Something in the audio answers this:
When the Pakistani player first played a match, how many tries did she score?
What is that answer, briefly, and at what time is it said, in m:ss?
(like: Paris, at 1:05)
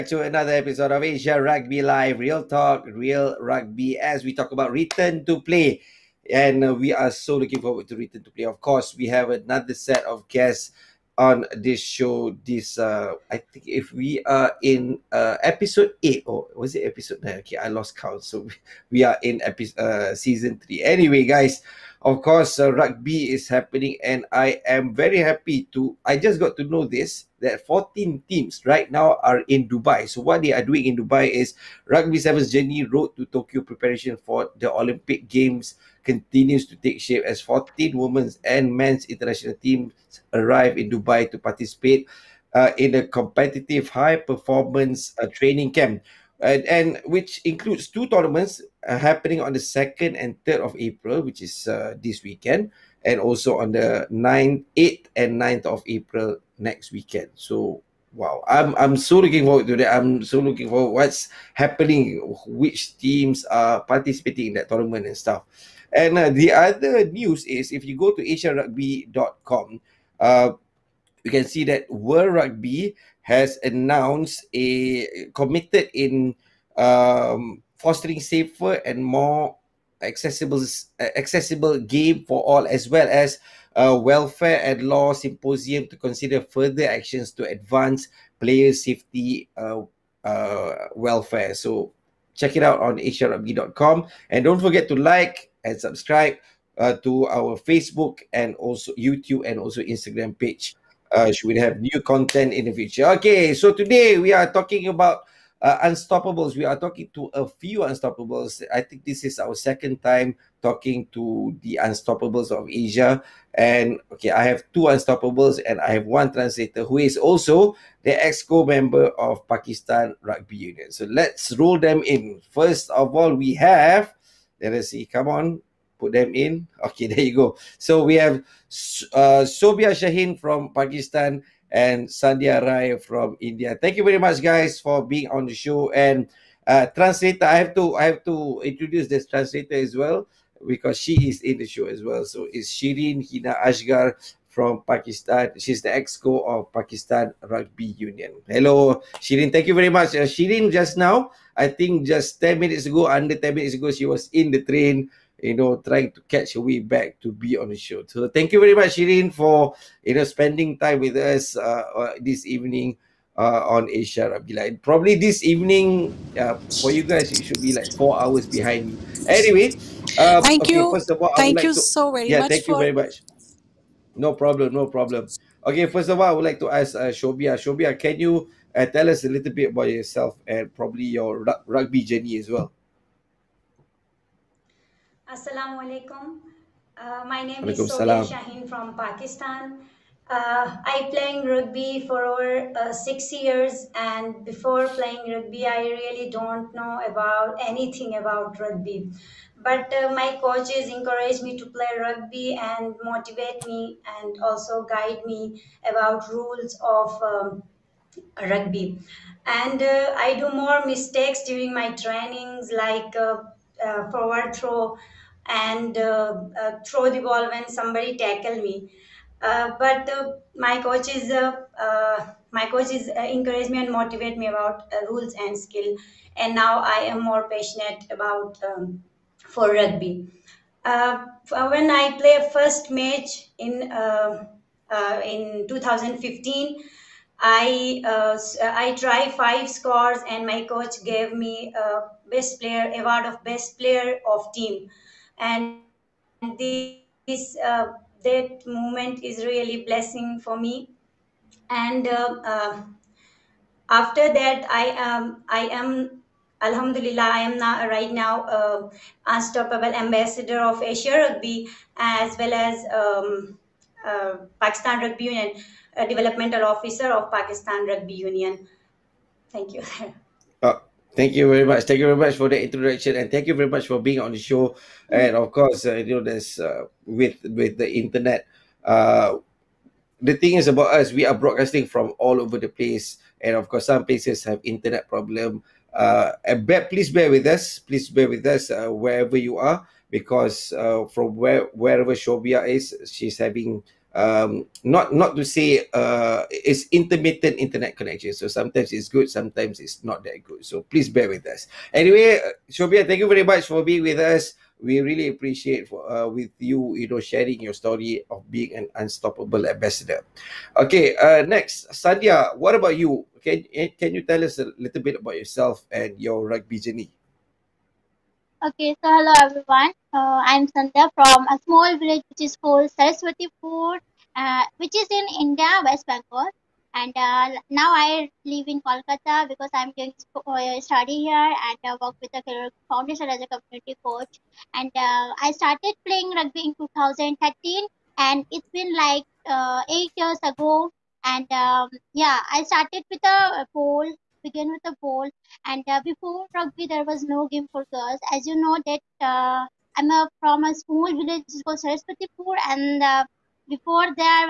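5, at 3:59.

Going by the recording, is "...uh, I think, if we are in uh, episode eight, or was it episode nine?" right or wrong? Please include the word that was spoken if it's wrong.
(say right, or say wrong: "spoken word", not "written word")
right.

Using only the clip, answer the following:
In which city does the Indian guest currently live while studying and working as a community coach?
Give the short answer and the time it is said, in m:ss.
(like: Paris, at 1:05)
Kolkata, at 5:28.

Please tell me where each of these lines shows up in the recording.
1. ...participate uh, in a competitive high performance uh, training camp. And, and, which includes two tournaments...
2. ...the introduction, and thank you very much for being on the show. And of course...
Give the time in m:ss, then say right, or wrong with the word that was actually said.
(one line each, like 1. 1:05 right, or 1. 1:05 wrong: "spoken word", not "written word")
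1. 0:41 right
2. 4:32 right.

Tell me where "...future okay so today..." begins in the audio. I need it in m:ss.
1:42.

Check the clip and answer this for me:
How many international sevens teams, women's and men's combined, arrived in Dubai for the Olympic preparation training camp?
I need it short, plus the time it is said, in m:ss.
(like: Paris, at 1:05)
14, at 0:37.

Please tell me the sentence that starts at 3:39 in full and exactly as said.
Uh, but my coach is my coach is encourage me and motivate me about rules and skill.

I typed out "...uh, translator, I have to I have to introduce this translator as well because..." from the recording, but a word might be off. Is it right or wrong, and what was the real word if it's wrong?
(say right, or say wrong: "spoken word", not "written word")
right.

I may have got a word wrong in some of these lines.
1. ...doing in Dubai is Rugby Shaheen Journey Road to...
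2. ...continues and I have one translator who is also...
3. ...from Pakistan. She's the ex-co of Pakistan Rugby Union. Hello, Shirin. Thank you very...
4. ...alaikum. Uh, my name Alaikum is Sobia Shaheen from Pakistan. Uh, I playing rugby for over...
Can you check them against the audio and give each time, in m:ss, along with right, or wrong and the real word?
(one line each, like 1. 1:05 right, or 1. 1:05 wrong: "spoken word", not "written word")
1. 0:30 wrong: "Sevens", not "Shaheen"
2. 1:54 wrong: "unstoppables", not "continues"
3. 2:24 right
4. 3:05 right.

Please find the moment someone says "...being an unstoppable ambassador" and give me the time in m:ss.
5:08.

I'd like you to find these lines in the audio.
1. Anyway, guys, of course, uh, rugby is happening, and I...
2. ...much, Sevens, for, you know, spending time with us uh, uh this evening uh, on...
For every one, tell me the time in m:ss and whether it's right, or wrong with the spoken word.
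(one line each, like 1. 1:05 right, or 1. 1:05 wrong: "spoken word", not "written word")
1. 0:20 right
2. 2:38 wrong: "Shirin", not "Sevens".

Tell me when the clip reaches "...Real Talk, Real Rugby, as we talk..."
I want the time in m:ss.
0:02.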